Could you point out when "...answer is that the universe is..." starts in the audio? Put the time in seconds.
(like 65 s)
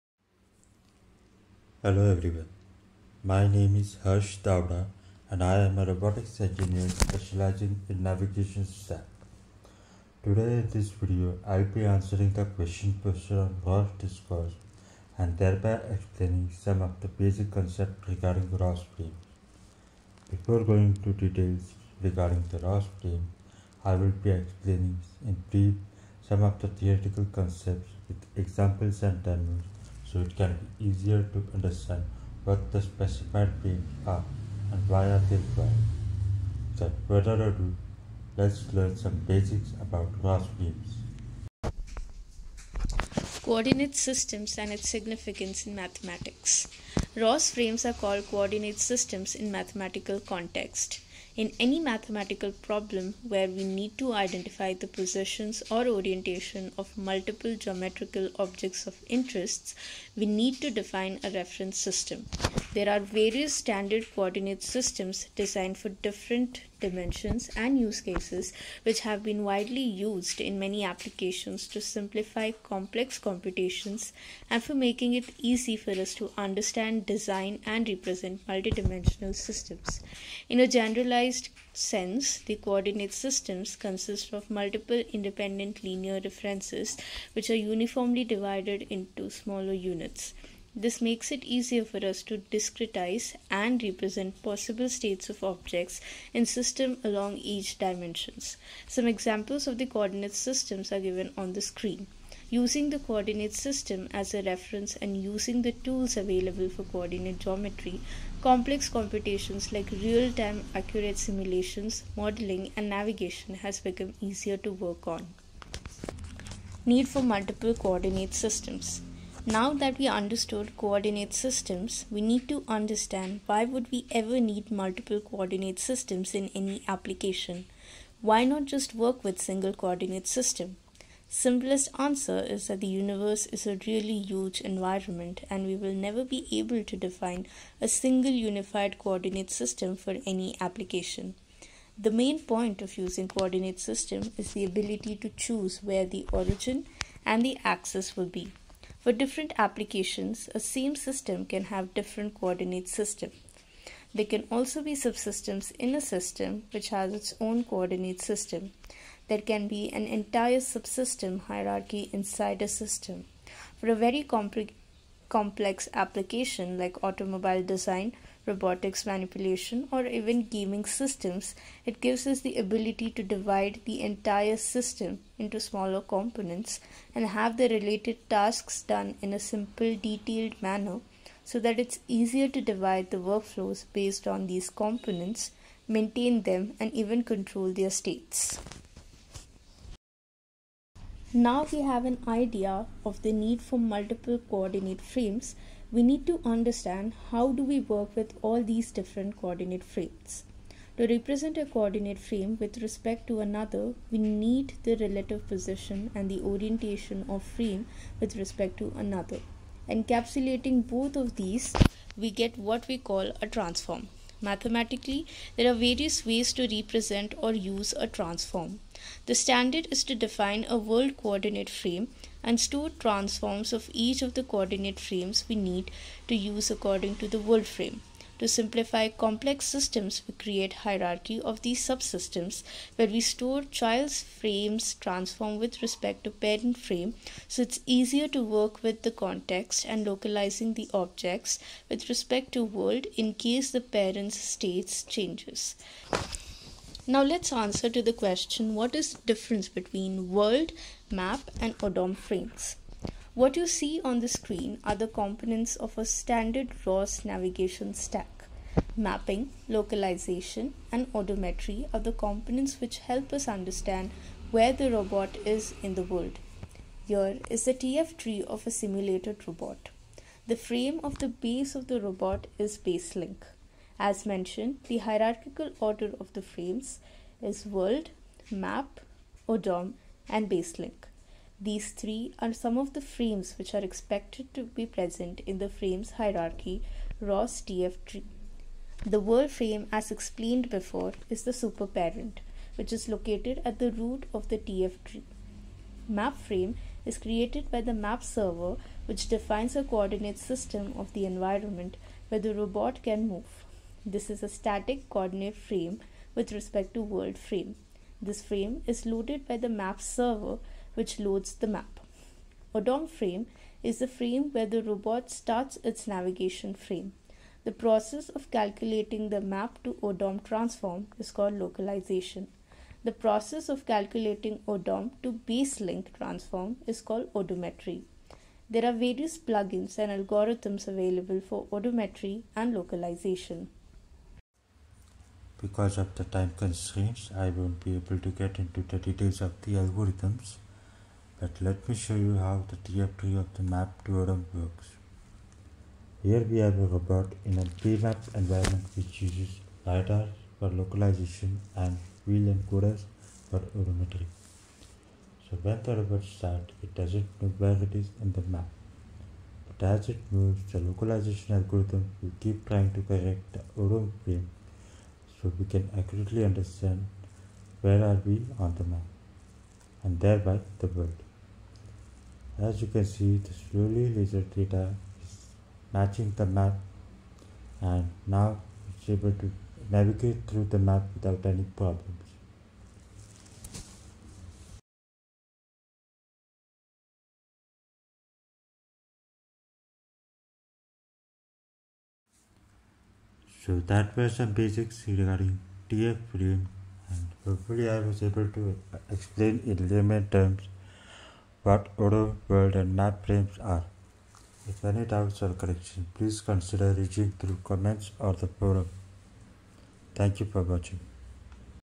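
131 s.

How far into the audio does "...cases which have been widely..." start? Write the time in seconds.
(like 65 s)
68 s.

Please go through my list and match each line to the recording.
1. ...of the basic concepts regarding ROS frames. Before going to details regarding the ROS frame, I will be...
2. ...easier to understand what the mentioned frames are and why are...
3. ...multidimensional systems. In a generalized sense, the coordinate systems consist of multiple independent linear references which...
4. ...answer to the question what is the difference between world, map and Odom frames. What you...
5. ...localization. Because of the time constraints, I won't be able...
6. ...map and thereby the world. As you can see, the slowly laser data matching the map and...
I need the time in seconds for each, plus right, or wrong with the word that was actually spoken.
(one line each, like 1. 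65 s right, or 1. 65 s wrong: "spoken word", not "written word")
1. 16 s right
2. 30 s wrong: "specified", not "mentioned"
3. 78 s right
4. 247 s right
5. 332 s right
6. 368 s right.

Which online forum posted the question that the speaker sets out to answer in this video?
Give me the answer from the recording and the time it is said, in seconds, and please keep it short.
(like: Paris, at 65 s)
ROS discourse, at 13 s.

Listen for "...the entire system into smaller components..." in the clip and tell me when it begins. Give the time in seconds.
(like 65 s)
173 s.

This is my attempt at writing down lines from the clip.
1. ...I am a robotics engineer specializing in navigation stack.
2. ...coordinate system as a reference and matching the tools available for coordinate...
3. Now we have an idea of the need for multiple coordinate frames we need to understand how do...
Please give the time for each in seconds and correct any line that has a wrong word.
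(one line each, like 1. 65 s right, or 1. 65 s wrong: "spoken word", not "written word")
1. 5 s right
2. 102 s wrong: "using", not "matching"
3. 191 s right.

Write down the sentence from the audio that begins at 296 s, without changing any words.
Map frame is created by the map server, which defines a coordinate system of the environment where the robot can move.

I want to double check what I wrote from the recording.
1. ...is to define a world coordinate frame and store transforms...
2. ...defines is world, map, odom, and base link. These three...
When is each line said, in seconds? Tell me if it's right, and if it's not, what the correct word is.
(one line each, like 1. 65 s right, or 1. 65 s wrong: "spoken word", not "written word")
1. 219 s right
2. 276 s wrong: "frames", not "defines".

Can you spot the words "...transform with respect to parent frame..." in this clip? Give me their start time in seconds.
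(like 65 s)
234 s.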